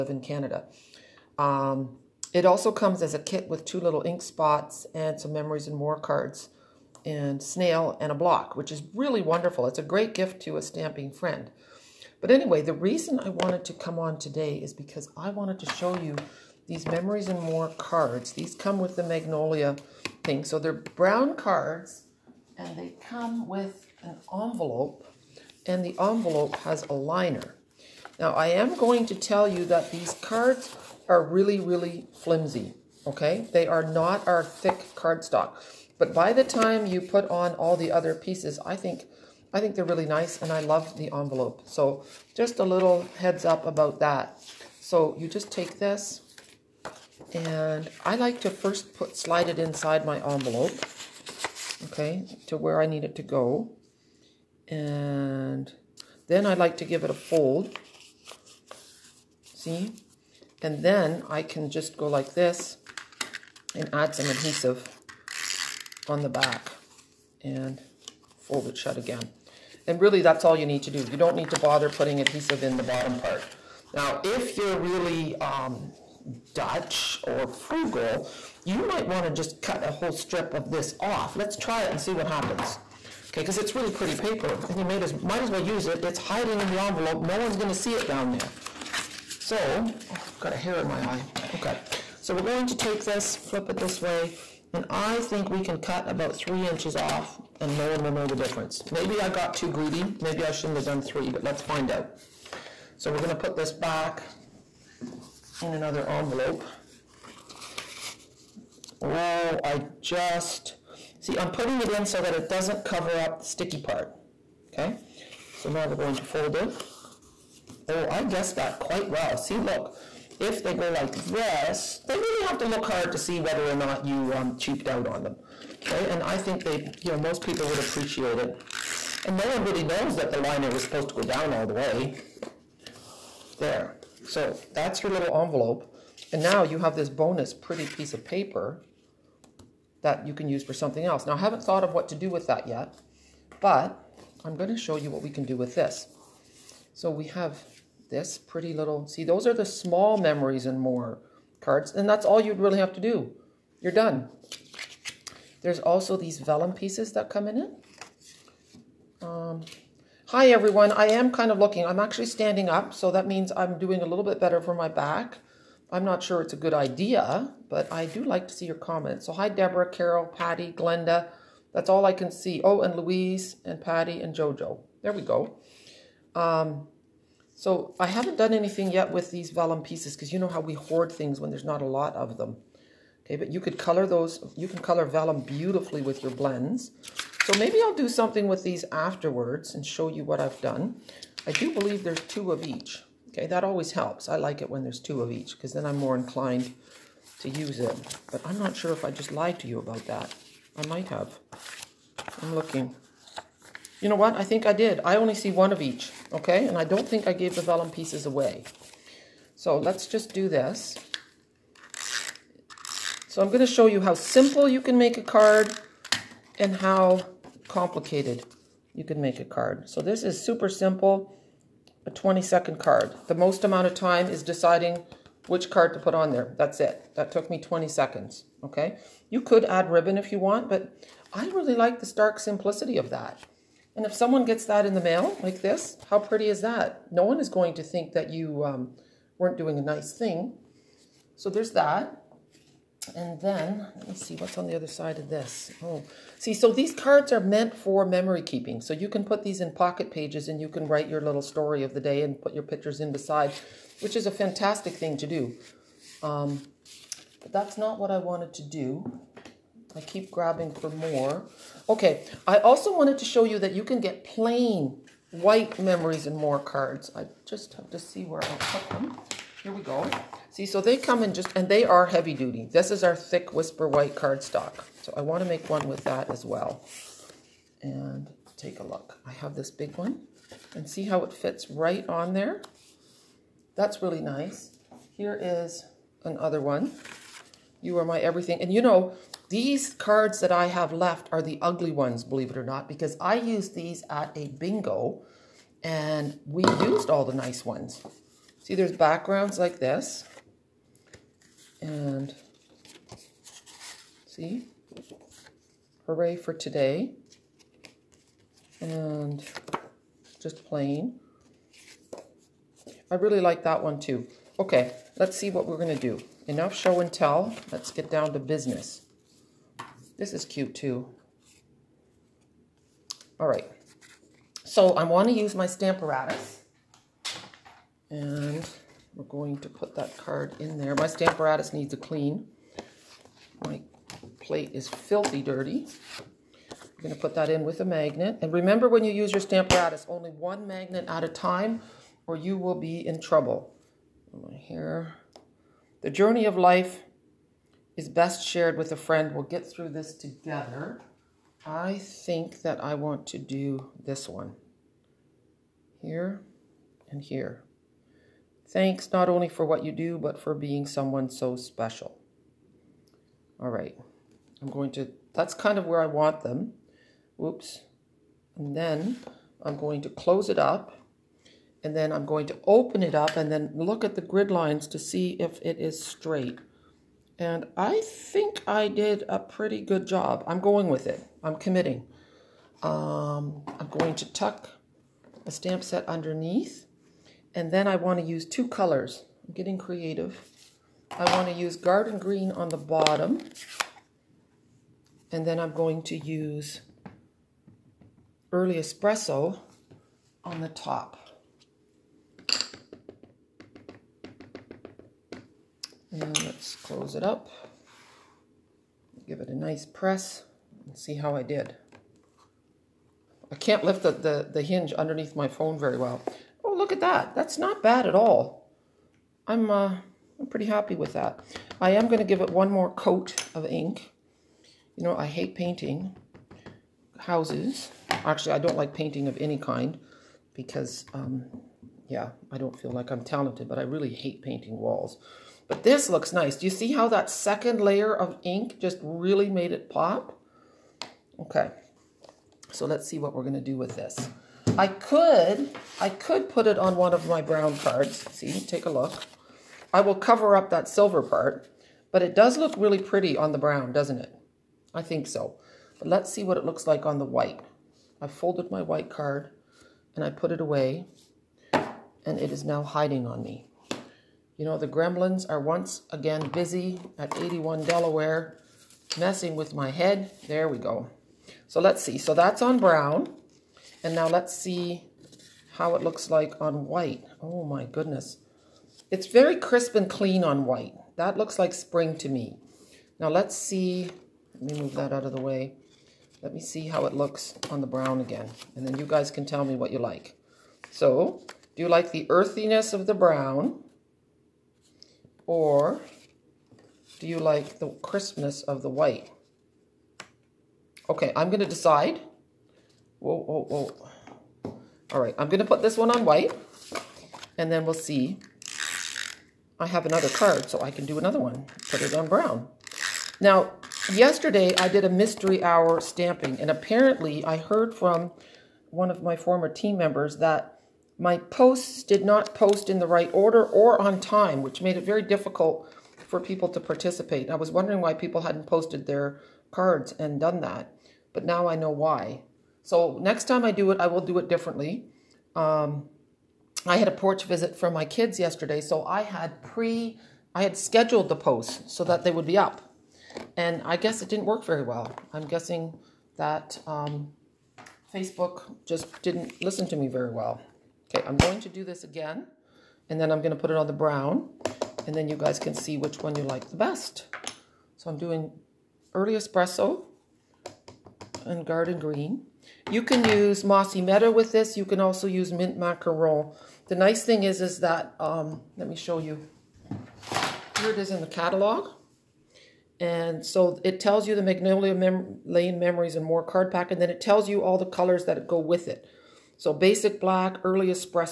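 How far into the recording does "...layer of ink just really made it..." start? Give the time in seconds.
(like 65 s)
437 s.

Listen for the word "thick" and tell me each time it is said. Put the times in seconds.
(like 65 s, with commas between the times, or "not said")
34 s, 273 s.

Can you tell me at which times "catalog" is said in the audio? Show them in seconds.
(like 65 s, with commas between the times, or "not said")
571 s.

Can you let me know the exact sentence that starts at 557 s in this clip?
So I'm doing early espresso and garden green.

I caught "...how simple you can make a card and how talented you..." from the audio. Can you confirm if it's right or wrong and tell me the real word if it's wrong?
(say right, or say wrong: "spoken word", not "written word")
wrong: "complicated", not "talented".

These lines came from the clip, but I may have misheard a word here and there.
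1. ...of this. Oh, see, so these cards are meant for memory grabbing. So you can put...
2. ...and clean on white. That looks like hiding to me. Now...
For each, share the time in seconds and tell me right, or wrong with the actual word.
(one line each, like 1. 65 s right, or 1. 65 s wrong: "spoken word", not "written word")
1. 245 s wrong: "keeping", not "grabbing"
2. 479 s wrong: "spring", not "hiding".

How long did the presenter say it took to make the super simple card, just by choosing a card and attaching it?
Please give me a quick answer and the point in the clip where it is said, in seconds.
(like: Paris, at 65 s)
20 seconds, at 222 s.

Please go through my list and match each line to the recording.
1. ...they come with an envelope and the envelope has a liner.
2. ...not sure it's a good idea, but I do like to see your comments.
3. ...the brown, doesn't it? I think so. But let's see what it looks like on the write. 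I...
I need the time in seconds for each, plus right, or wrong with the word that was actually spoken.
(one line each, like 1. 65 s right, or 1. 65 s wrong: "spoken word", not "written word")
1. 22 s right
2. 166 s right
3. 453 s wrong: "white", not "write".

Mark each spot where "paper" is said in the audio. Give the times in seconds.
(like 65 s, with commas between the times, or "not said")
84 s, 138 s.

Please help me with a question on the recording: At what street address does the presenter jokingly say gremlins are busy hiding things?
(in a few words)
81 Delaware.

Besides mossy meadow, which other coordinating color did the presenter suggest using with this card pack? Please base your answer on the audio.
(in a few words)
Mint Macaron.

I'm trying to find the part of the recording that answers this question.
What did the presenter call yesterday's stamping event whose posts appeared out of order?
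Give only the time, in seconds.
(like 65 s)
515 s.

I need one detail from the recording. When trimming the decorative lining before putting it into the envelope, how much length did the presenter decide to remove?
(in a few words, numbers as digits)
3 inches.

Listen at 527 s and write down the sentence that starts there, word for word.
I was wondering why people hadn't posted their cards and done that, but now I know why.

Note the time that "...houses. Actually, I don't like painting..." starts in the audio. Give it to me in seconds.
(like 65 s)
427 s.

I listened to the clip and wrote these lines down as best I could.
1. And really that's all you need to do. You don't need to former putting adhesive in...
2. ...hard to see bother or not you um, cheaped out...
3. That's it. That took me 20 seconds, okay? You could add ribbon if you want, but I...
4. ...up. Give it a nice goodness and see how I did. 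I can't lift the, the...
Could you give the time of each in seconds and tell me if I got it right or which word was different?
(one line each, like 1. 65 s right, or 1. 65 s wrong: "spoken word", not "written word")
1. 69 s wrong: "bother", not "former"
2. 122 s wrong: "whether", not "bother"
3. 226 s right
4. 407 s wrong: "press", not "goodness".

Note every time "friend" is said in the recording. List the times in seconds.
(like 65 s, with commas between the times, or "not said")
11 s, 348 s.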